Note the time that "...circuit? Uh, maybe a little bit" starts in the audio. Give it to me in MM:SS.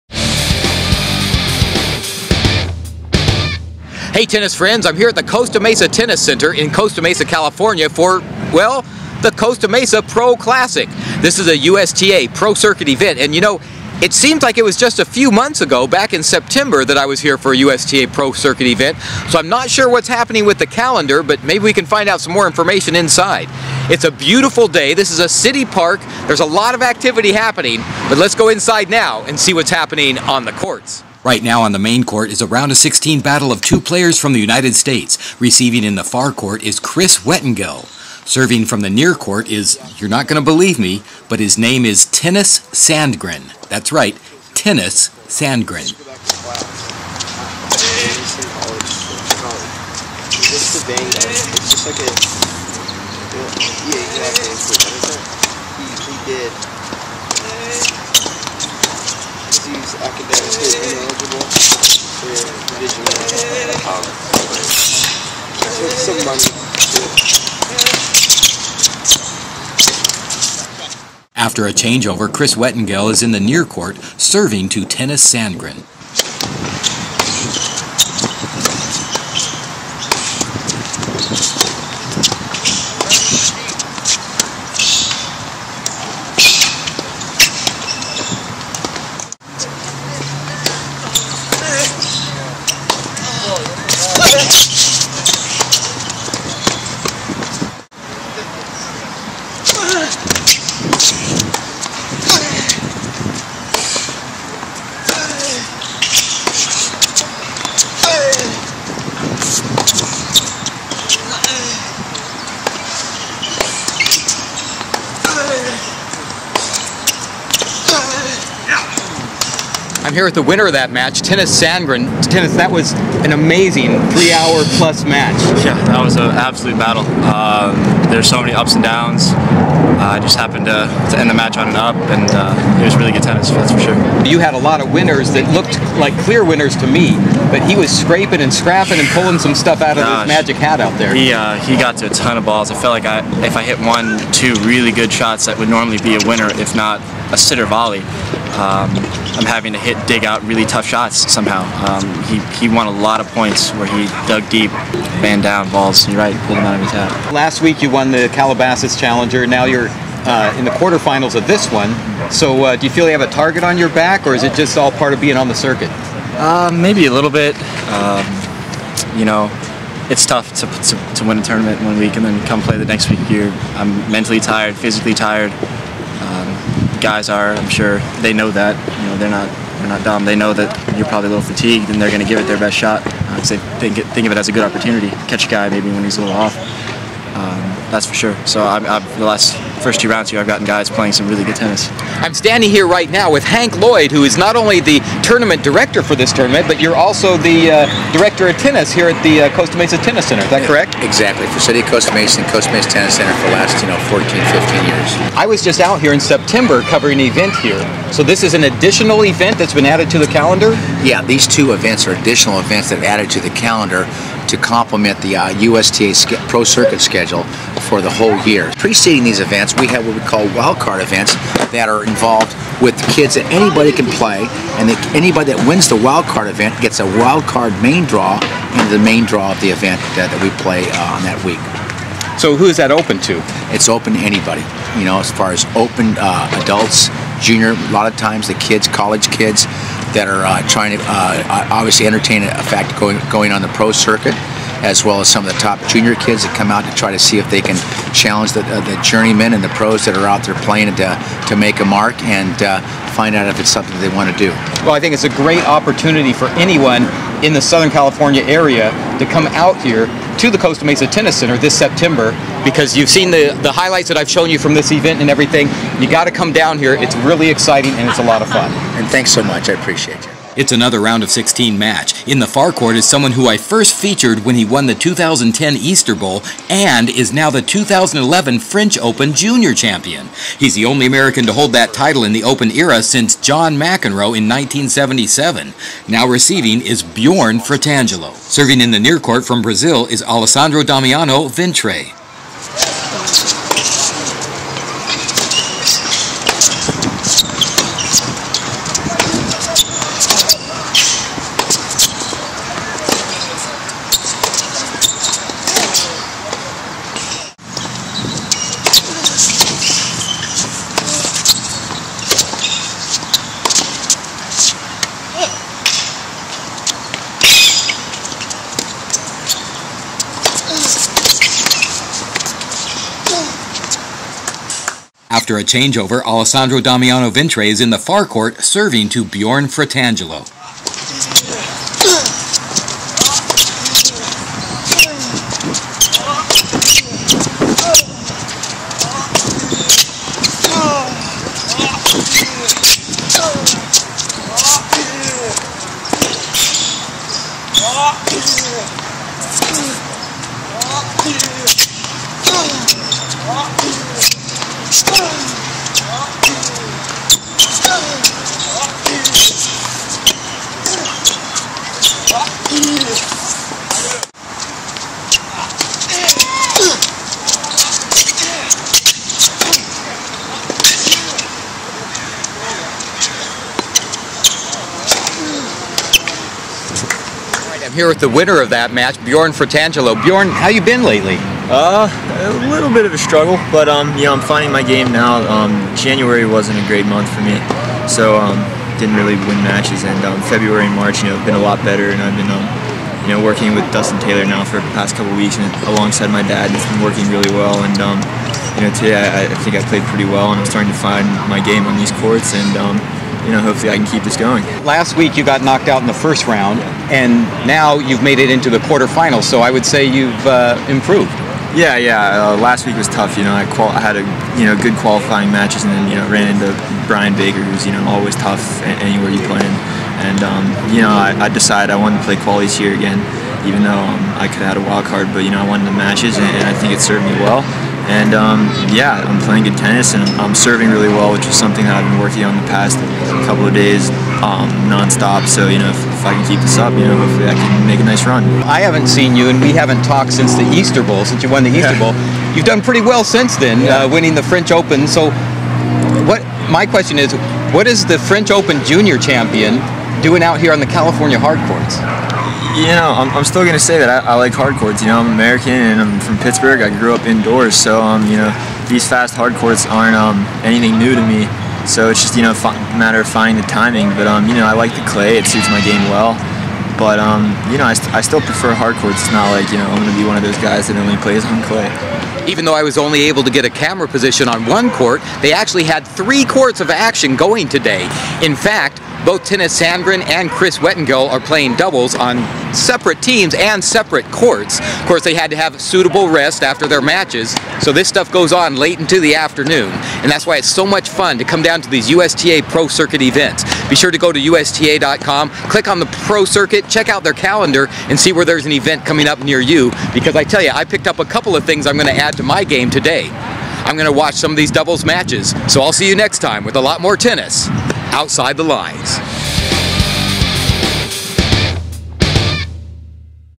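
02:45.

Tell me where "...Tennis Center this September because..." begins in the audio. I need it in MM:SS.
04:21.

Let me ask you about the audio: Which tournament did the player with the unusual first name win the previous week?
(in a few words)
Calabasas Challenger.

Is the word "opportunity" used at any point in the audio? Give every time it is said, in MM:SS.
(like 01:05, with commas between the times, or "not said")
03:04, 04:15.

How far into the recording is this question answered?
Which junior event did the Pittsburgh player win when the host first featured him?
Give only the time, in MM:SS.
04:34.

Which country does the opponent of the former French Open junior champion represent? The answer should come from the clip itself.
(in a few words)
Brazil.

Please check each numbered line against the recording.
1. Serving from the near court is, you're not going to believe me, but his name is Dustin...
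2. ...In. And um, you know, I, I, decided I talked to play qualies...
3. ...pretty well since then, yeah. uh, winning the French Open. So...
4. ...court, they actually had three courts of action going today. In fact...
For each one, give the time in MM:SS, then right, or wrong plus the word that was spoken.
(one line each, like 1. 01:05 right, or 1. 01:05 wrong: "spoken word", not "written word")
1. 00:38 wrong: "Tennys", not "Dustin"
2. 06:59 wrong: "wanted", not "talked"
3. 07:22 right
4. 07:54 right.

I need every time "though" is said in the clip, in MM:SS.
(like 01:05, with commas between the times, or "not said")
07:03, 07:52.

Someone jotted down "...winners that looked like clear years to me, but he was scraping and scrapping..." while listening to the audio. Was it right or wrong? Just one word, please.
wrong.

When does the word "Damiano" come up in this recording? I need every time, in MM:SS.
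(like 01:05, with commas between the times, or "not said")
04:50, 05:26.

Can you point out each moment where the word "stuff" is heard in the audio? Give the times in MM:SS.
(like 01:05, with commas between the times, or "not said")
02:19, 08:08.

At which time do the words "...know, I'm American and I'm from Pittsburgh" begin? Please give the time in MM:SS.
07:35.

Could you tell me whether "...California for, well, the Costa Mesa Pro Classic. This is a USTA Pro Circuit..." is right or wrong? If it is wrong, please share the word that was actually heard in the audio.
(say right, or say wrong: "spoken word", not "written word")
right.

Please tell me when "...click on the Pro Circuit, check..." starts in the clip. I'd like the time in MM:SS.
08:15.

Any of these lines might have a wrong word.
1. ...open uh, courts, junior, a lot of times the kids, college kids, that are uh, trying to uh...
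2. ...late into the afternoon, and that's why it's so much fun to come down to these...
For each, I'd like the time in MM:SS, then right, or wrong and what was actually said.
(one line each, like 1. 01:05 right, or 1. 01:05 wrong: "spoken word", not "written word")
1. 03:55 wrong: "adults", not "courts"
2. 08:08 right.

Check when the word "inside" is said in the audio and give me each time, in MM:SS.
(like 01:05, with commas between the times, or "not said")
00:22, 00:28.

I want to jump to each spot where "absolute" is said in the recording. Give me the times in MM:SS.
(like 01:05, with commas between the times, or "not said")
02:06.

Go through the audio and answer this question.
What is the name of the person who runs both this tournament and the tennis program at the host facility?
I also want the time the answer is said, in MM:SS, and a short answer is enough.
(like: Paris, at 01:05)
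Hank Lloyd, at 03:13.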